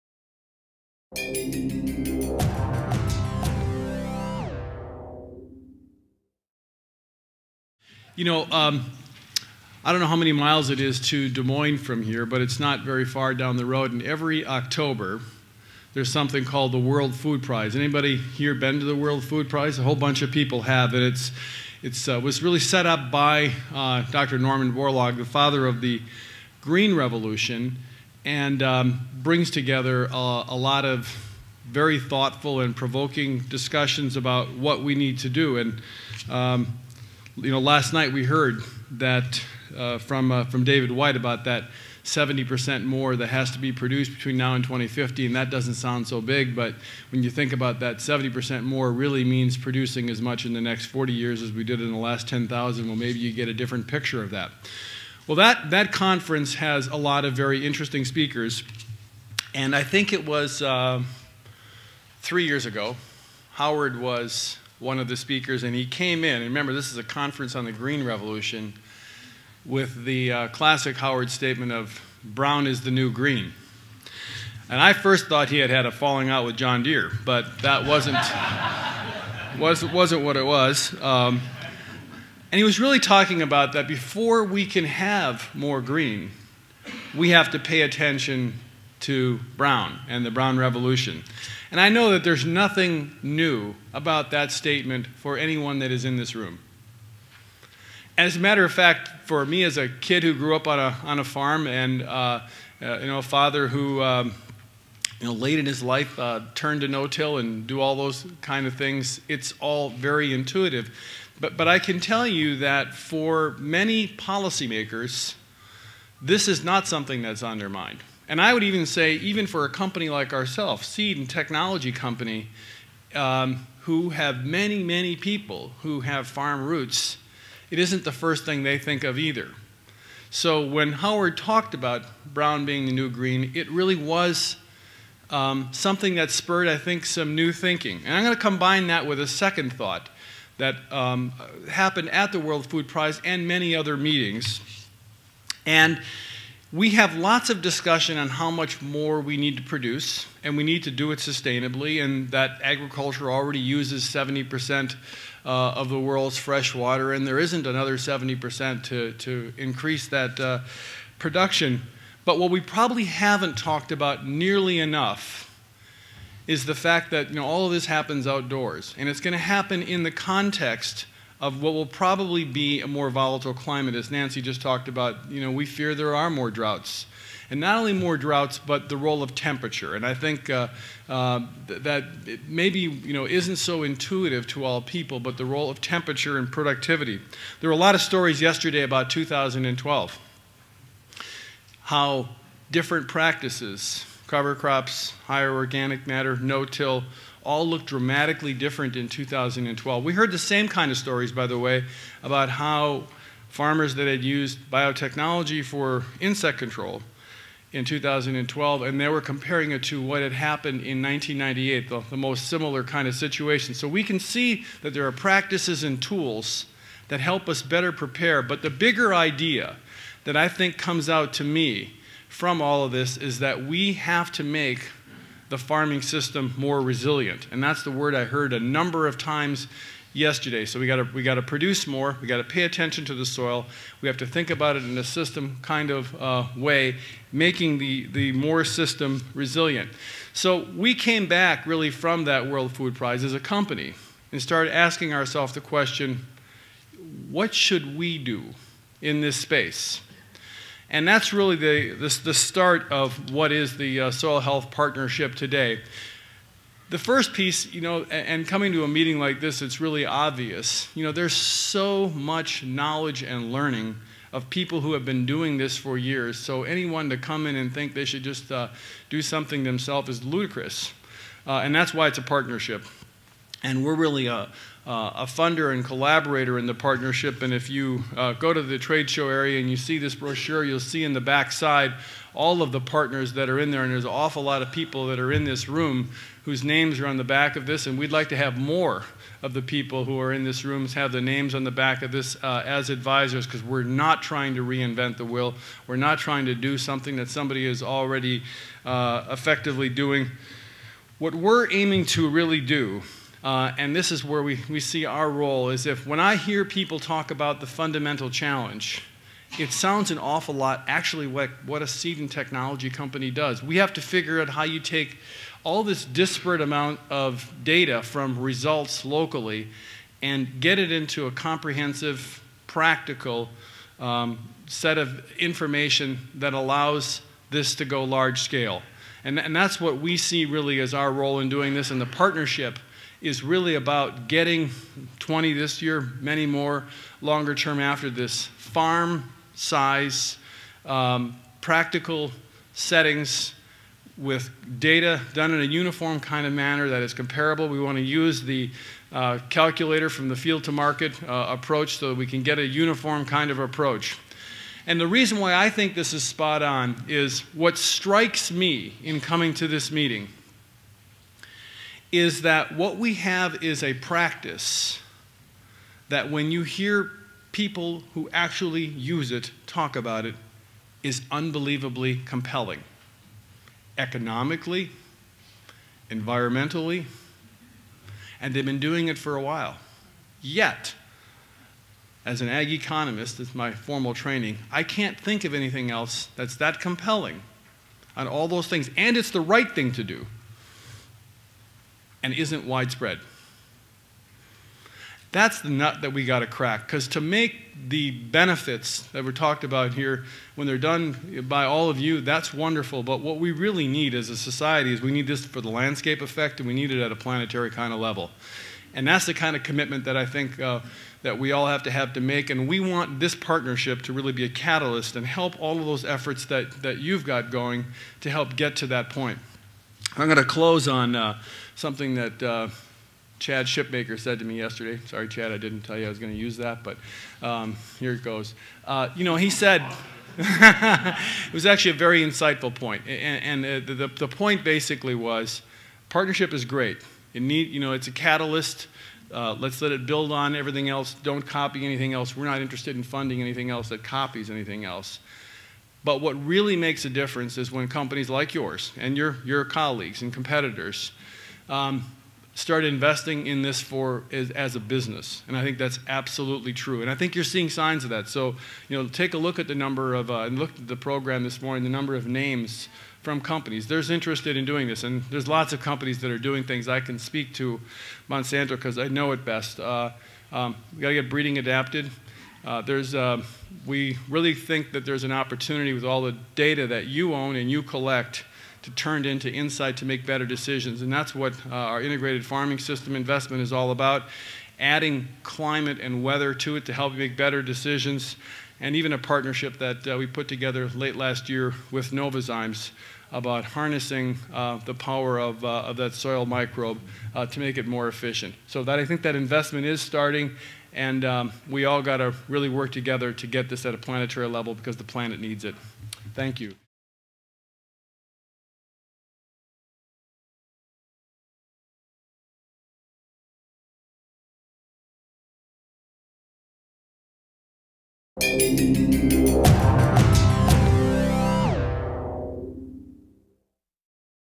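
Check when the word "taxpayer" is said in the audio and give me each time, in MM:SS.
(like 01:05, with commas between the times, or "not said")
not said.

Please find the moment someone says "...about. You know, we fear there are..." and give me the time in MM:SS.
02:54.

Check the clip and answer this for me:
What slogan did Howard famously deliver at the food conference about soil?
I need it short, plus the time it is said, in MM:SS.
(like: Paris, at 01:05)
Brown is the new green, at 01:12.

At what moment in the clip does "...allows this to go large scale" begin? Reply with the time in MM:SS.
05:26.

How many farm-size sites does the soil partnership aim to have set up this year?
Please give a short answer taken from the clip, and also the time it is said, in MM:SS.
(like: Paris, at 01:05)
20, at 05:35.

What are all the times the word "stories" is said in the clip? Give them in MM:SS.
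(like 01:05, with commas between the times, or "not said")
03:08, 03:20.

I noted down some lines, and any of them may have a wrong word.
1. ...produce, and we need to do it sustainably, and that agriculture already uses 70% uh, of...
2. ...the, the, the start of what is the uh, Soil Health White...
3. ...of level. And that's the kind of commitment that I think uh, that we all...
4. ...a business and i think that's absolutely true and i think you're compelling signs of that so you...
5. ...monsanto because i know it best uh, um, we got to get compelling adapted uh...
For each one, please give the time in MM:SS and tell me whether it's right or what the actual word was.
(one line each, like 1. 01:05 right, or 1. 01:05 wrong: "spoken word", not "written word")
1. 02:29 right
2. 04:11 wrong: "Partnership", not "White"
3. 06:47 right
4. 07:34 wrong: "seeing", not "compelling"
5. 07:48 wrong: "breeding", not "compelling".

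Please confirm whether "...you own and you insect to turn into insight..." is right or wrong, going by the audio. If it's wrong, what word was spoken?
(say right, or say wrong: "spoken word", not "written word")
wrong: "collect", not "insect".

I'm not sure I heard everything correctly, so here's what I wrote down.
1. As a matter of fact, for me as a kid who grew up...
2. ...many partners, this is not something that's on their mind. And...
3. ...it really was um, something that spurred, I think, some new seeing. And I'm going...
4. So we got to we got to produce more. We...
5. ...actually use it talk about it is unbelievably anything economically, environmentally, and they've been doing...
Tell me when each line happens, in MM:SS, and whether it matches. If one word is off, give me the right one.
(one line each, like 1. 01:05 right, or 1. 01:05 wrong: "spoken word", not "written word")
1. 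01:38 right
2. 01:53 wrong: "policymakers", not "partners"
3. 02:13 wrong: "thinking", not "seeing"
4. 03:50 right
5. 06:08 wrong: "compelling", not "anything".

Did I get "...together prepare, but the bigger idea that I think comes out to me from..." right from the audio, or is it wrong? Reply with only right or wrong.
wrong.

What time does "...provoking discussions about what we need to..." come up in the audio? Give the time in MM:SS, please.
00:32.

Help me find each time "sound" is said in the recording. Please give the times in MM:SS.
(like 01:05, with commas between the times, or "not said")
00:45, 05:09.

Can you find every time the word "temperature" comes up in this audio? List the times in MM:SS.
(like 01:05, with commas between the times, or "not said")
02:59, 03:05.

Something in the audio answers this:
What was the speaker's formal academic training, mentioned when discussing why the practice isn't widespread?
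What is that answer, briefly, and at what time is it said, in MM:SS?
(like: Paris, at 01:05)
Ag economist, at 06:22.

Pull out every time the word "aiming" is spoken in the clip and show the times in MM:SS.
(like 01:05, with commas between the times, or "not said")
05:01.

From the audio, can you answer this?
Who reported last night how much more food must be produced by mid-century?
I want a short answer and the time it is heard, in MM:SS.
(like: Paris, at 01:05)
David White, at 00:40.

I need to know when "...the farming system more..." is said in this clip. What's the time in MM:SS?
03:45.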